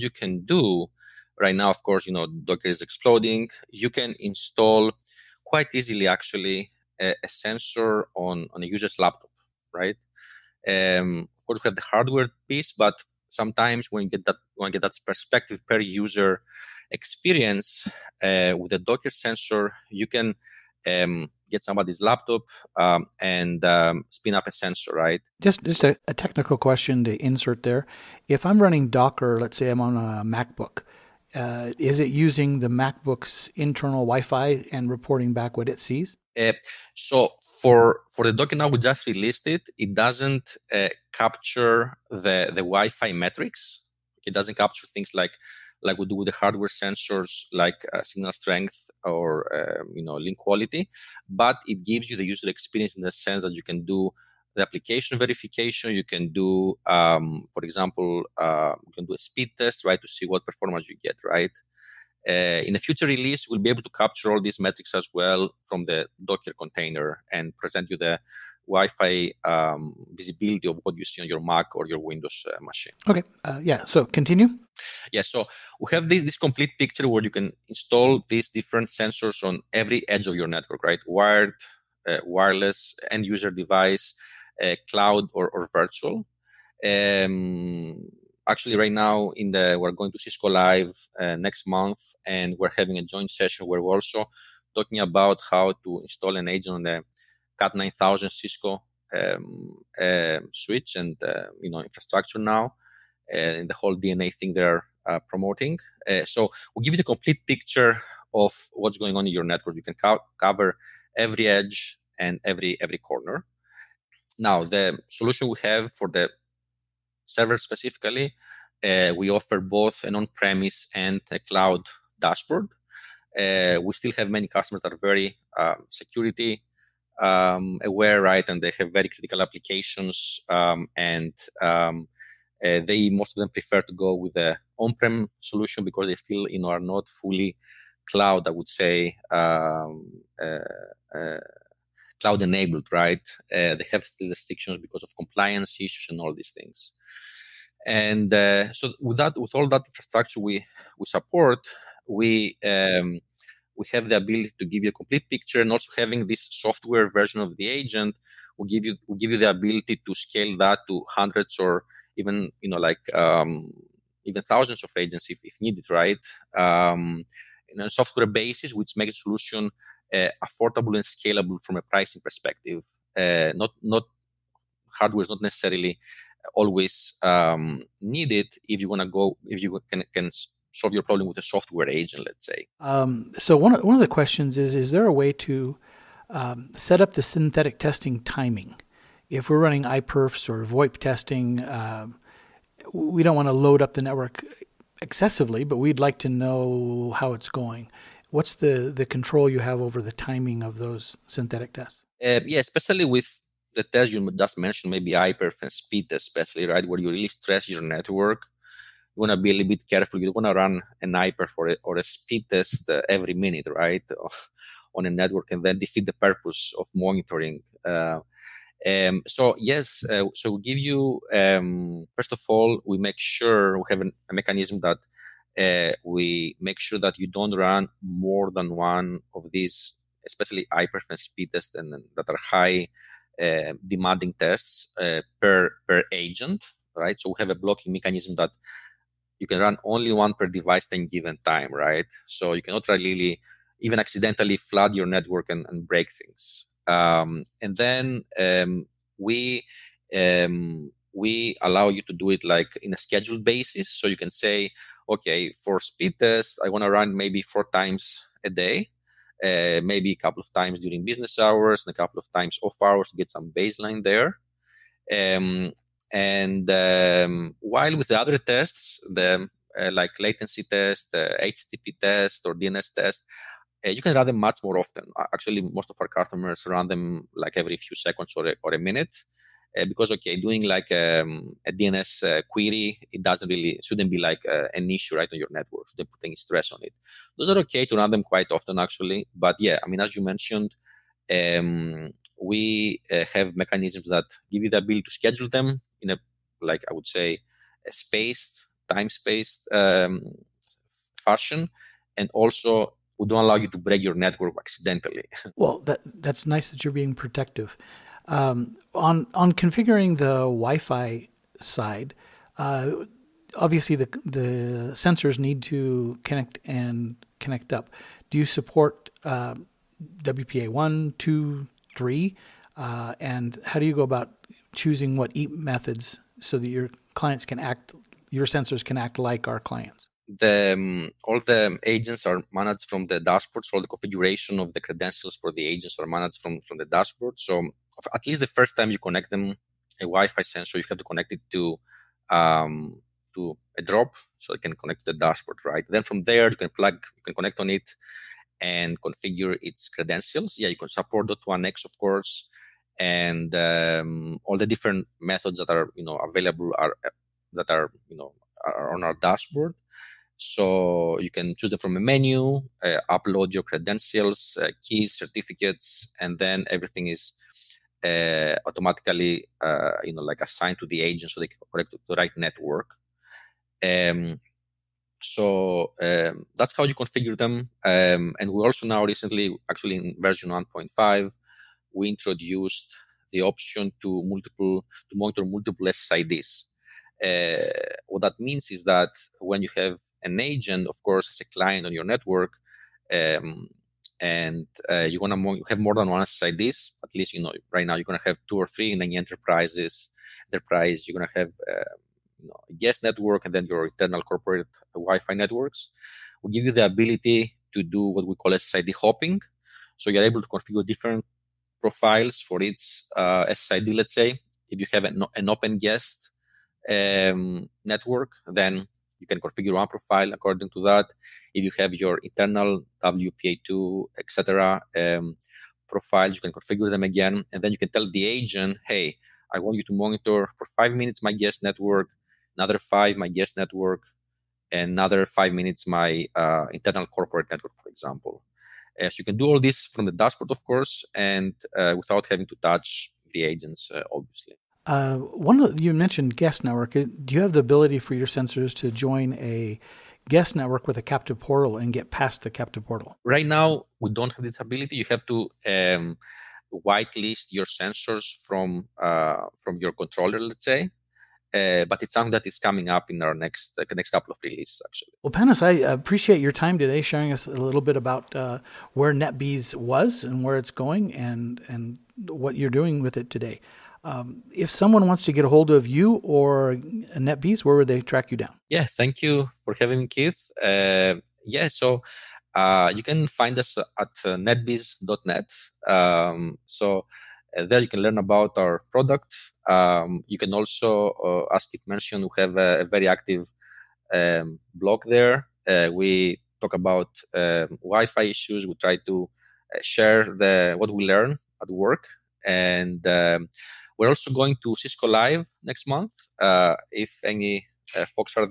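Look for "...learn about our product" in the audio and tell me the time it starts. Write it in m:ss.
8:08.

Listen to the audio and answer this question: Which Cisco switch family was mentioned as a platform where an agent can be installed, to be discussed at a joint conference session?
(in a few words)
Cat 9000.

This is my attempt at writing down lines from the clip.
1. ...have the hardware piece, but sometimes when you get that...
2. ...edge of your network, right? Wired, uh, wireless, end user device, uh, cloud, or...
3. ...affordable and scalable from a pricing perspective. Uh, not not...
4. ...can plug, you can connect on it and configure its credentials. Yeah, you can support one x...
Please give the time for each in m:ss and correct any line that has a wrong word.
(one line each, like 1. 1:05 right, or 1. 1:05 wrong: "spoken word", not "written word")
1. 0:11 right
2. 1:20 right
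3. 2:50 right
4. 5:46 right.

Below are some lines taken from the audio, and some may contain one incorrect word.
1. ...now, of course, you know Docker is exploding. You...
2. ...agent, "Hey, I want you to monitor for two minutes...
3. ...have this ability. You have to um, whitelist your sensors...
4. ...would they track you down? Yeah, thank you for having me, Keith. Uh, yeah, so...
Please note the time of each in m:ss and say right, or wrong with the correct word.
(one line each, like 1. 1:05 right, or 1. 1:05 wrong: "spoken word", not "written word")
1. 0:01 right
2. 7:08 wrong: "five", not "two"
3. 7:34 right
4. 7:57 right.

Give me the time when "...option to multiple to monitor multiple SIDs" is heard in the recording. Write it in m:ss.
6:23.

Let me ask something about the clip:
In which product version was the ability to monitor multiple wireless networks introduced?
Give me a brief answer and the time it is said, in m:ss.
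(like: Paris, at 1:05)
1.5, at 6:20.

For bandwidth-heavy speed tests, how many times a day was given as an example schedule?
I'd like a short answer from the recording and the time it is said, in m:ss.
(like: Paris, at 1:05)
4, at 4:17.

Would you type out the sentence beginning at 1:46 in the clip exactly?
Uh, so we'll give you the complete picture of what's going on in your network.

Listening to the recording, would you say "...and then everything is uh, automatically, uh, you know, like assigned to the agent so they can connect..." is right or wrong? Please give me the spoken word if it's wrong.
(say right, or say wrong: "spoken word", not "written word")
right.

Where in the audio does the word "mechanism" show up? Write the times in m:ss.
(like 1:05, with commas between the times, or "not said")
3:44, 3:57, 4:53.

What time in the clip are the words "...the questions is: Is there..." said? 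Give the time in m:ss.
3:04.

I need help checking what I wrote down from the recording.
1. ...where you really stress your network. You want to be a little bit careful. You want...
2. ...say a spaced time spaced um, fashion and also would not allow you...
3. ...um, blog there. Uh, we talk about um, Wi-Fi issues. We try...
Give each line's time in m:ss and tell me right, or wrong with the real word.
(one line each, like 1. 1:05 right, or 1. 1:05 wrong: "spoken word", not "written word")
1. 3:26 right
2. 4:57 right
3. 8:14 right.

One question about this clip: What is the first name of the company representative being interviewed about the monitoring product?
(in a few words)
Panos.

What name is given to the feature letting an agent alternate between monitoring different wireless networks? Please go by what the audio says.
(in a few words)
SID hopping.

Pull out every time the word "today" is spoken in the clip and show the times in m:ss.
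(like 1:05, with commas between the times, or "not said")
7:46, 7:53.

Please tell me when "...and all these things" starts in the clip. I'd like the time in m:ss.
2:26.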